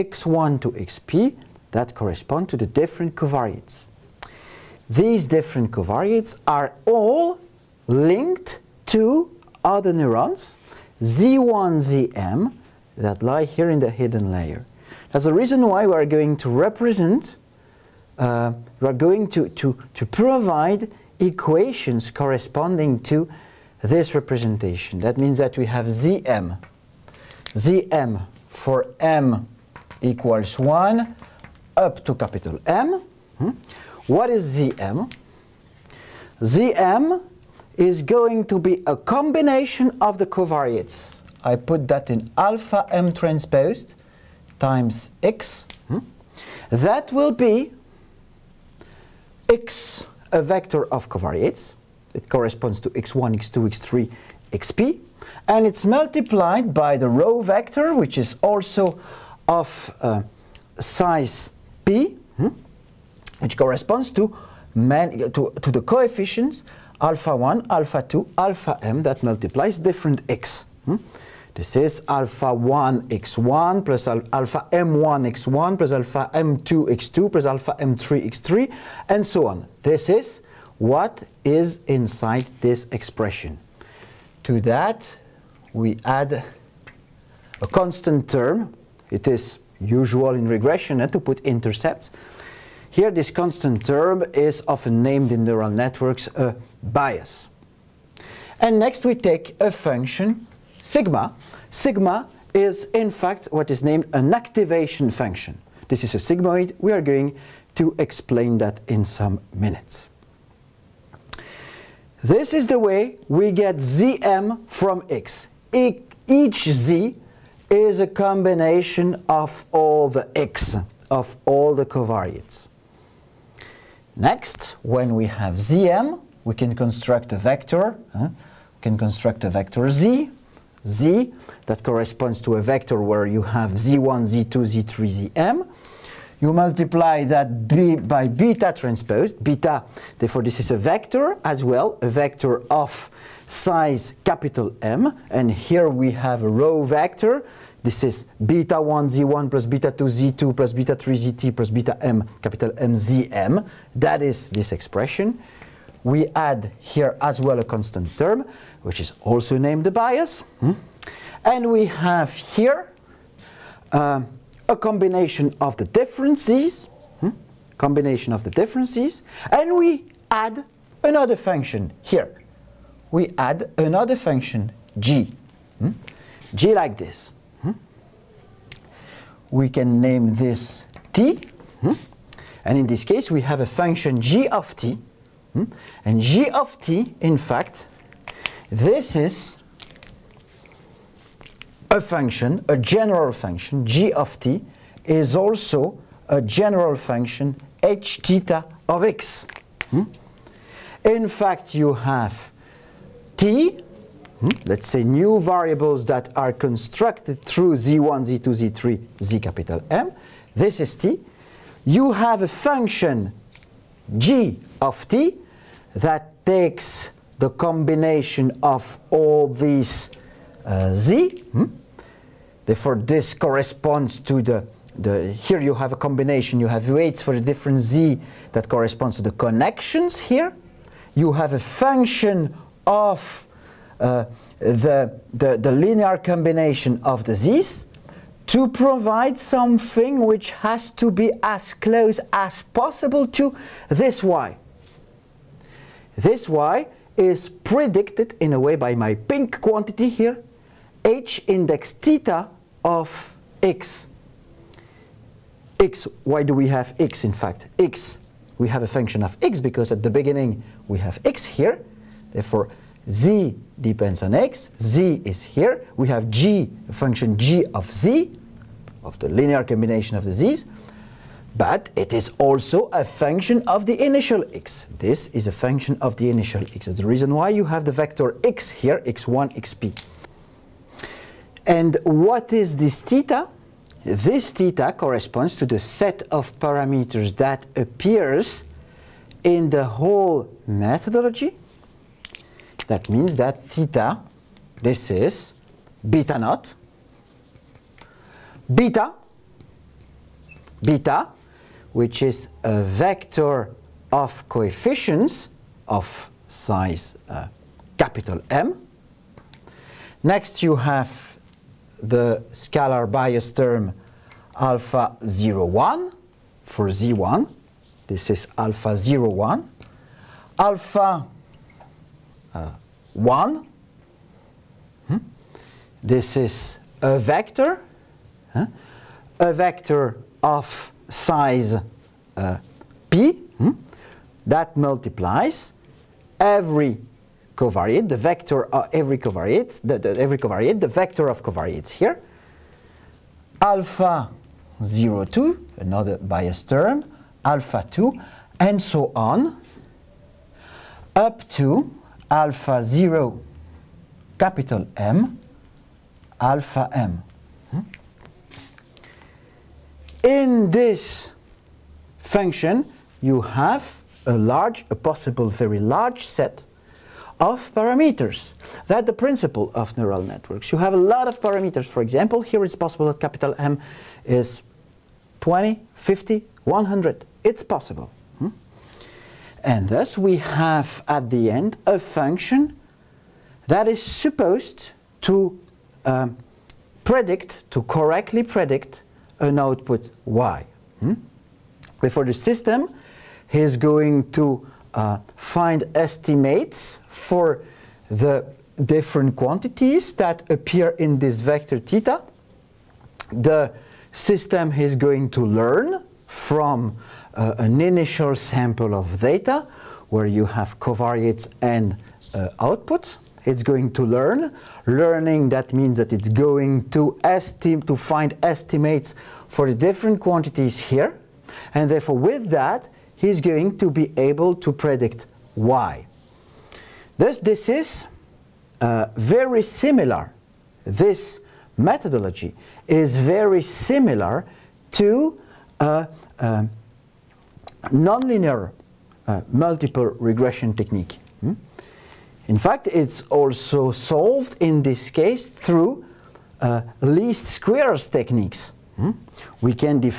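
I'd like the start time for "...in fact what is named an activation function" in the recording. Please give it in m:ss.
1:42.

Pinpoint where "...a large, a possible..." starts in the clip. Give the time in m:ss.
6:04.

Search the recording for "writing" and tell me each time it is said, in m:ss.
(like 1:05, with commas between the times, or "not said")
not said.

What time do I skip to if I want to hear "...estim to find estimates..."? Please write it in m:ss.
6:57.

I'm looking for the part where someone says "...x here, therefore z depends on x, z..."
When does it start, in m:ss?
4:21.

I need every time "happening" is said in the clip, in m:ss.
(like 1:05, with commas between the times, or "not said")
not said.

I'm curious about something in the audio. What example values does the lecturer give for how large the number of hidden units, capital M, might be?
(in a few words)
20, 50, 100.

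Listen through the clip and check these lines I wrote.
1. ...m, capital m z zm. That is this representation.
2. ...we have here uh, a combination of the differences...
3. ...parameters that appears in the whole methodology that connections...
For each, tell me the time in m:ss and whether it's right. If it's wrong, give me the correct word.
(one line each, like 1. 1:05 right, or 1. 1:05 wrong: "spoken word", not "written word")
1. 2:32 wrong: "expression", not "representation"
2. 2:41 right
3. 4:46 wrong: "means", not "connections".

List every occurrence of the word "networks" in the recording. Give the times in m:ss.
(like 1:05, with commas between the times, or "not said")
1:35, 6:10.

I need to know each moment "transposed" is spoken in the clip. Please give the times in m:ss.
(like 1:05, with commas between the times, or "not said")
0:43, 2:18.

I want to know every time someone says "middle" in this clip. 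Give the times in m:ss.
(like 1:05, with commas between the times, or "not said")
not said.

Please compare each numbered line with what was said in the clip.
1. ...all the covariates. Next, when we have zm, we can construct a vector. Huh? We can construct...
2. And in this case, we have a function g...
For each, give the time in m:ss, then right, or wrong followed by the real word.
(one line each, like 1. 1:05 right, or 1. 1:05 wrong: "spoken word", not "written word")
1. 2:01 right
2. 3:02 right.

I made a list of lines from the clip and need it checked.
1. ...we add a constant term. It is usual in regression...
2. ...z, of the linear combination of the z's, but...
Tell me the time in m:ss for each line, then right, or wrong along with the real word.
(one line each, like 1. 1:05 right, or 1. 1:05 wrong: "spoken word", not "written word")
1. 1:25 right
2. 4:27 right.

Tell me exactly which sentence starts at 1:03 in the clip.
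which corresponds to, to, to the coefficients alpha 1, alpha 2, alpha m that multiplies different x.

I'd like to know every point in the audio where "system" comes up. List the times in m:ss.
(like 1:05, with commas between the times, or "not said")
6:32, 6:44.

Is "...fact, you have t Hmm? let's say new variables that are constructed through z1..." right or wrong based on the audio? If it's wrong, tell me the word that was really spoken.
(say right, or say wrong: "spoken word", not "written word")
right.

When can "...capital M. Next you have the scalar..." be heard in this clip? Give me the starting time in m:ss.
5:07.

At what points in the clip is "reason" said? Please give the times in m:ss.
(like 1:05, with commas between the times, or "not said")
0:15, 4:37.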